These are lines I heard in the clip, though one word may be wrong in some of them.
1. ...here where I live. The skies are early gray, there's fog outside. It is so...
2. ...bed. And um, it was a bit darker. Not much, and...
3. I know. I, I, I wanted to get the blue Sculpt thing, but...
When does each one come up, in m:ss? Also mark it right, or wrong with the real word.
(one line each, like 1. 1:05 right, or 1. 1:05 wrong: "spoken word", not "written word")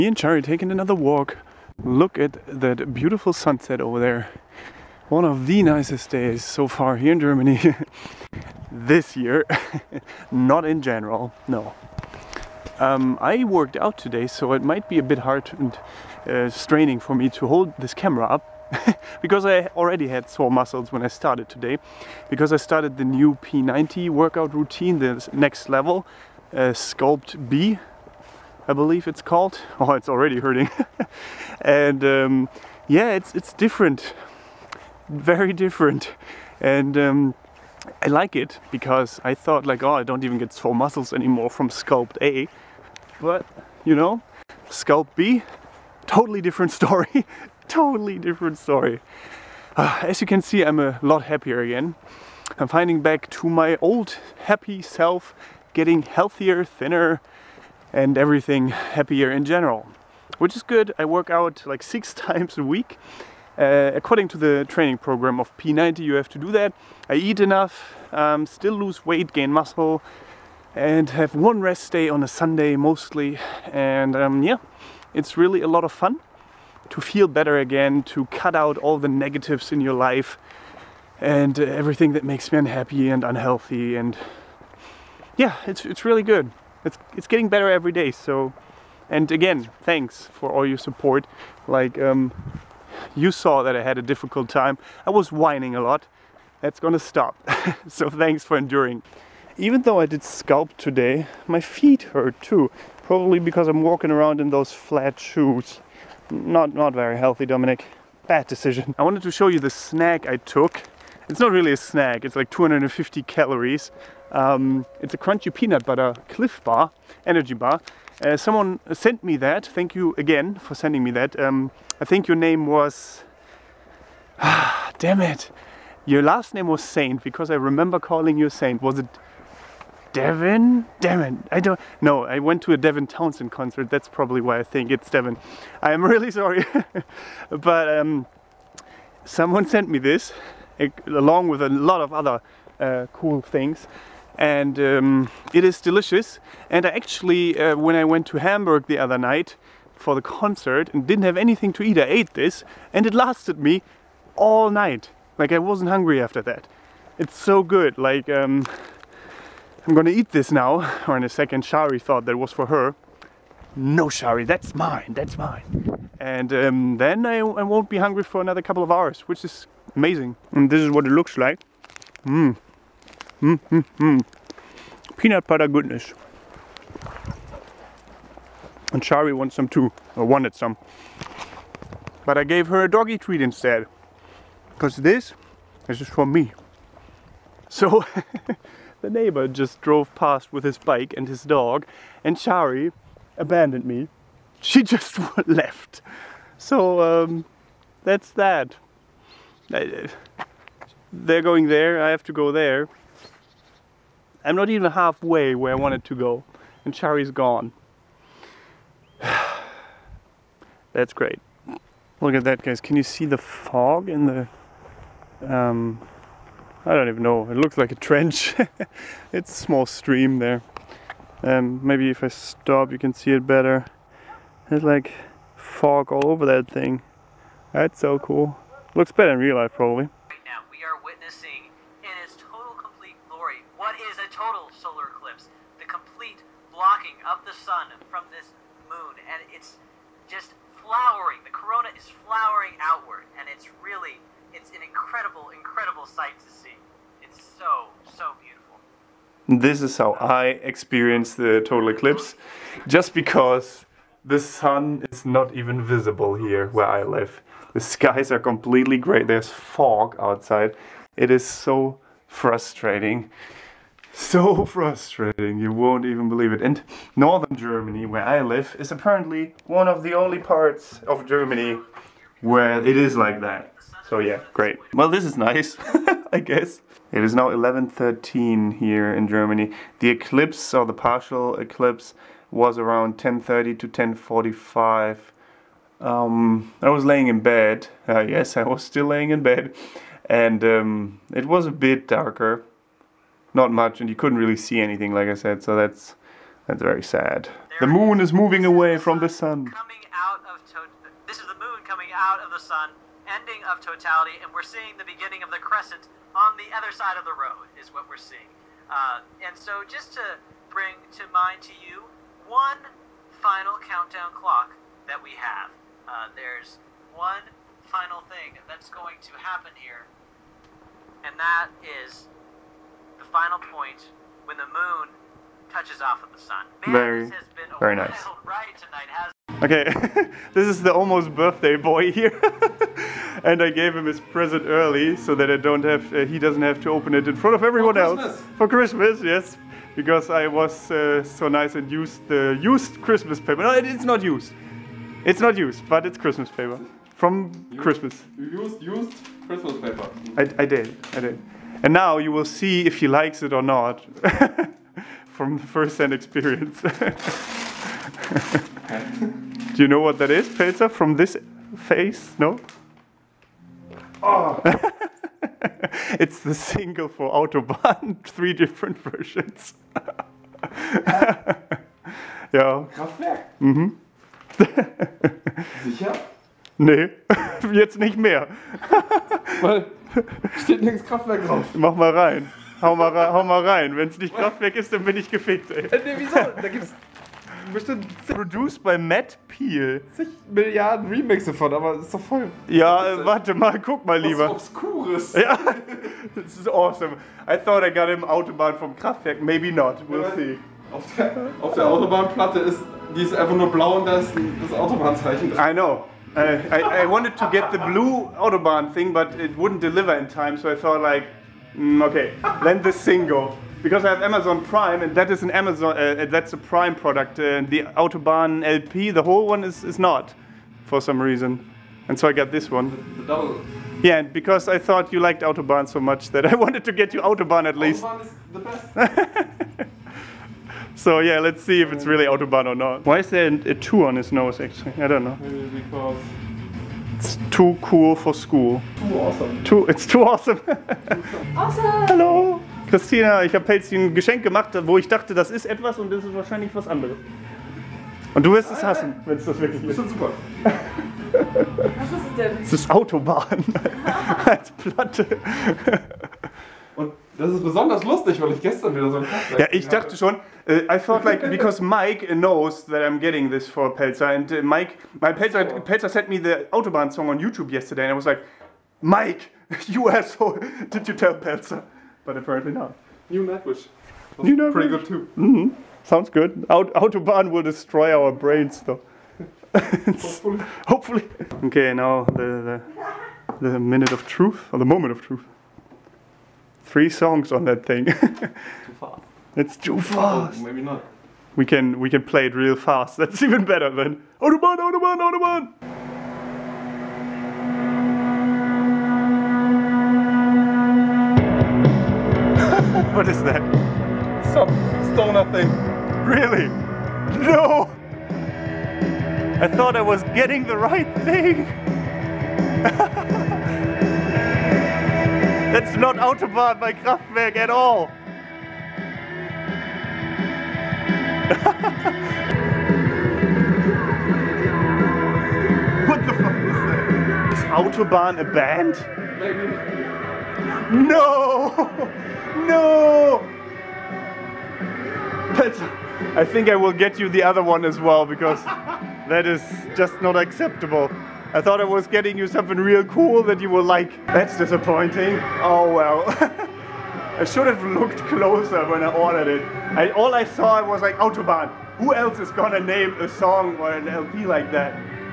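1. 4:16 wrong: "completely", not "early"
2. 4:49 right
3. 6:45 wrong: "Autobahn", not "Sculpt".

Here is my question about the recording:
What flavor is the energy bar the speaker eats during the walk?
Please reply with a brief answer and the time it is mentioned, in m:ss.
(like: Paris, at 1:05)
Crunchy peanut butter, at 1:55.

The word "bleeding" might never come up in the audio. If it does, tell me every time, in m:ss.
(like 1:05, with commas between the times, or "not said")
not said.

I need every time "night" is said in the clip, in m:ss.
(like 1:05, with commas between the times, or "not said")
2:29, 2:34.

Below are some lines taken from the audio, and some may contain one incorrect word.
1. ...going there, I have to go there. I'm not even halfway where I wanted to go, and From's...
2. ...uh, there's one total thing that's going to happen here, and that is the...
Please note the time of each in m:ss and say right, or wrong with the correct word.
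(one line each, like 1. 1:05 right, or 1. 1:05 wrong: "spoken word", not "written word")
1. 3:21 wrong: "Shari", not "From"
2. 5:16 wrong: "final", not "total".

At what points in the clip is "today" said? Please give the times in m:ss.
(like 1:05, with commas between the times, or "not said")
0:13, 0:21, 1:40.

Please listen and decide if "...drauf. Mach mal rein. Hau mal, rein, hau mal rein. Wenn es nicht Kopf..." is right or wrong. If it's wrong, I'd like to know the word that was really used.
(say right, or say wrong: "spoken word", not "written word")
wrong: "Kraftwerk", not "Kopf".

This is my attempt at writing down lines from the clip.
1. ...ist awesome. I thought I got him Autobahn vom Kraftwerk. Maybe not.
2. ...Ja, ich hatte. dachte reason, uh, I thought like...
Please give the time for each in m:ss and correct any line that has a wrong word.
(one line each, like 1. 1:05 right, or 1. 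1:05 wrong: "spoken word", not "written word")
1. 6:36 right
2. 7:39 wrong: "schon", not "reason".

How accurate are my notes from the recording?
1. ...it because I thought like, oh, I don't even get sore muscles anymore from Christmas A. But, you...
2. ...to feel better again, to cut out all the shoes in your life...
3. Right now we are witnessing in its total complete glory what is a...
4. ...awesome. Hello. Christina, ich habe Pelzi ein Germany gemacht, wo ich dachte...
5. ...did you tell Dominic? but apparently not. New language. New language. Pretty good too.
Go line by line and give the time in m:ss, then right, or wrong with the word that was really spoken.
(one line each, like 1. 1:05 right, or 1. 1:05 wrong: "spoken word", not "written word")
1. 0:38 wrong: "Sculpt", not "Christmas"
2. 1:16 wrong: "negatives", not "shoes"
3. 3:50 right
4. 7:21 wrong: "Geschenk", not "Germany"
5. 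7:50 wrong: "Pelzer", not "Dominic".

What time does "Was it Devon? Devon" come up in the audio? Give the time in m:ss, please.
2:08.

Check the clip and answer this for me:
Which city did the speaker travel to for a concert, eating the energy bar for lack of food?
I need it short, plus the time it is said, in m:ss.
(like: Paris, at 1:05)
Hamburg, at 2:28.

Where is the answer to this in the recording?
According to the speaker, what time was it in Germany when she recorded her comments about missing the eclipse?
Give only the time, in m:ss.
4:37.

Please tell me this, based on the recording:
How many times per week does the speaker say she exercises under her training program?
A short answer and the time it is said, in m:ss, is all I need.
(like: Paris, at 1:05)
6, at 1:01.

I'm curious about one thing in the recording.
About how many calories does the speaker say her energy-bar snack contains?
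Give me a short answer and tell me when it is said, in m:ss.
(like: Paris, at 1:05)
250, at 1:52.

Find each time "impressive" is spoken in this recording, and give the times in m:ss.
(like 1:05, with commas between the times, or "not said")
not said.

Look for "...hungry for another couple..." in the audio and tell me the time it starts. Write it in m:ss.
2:47.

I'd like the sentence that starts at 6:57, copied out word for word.
Uh, the Autobahn LP, the whole one is, is not, for some reason.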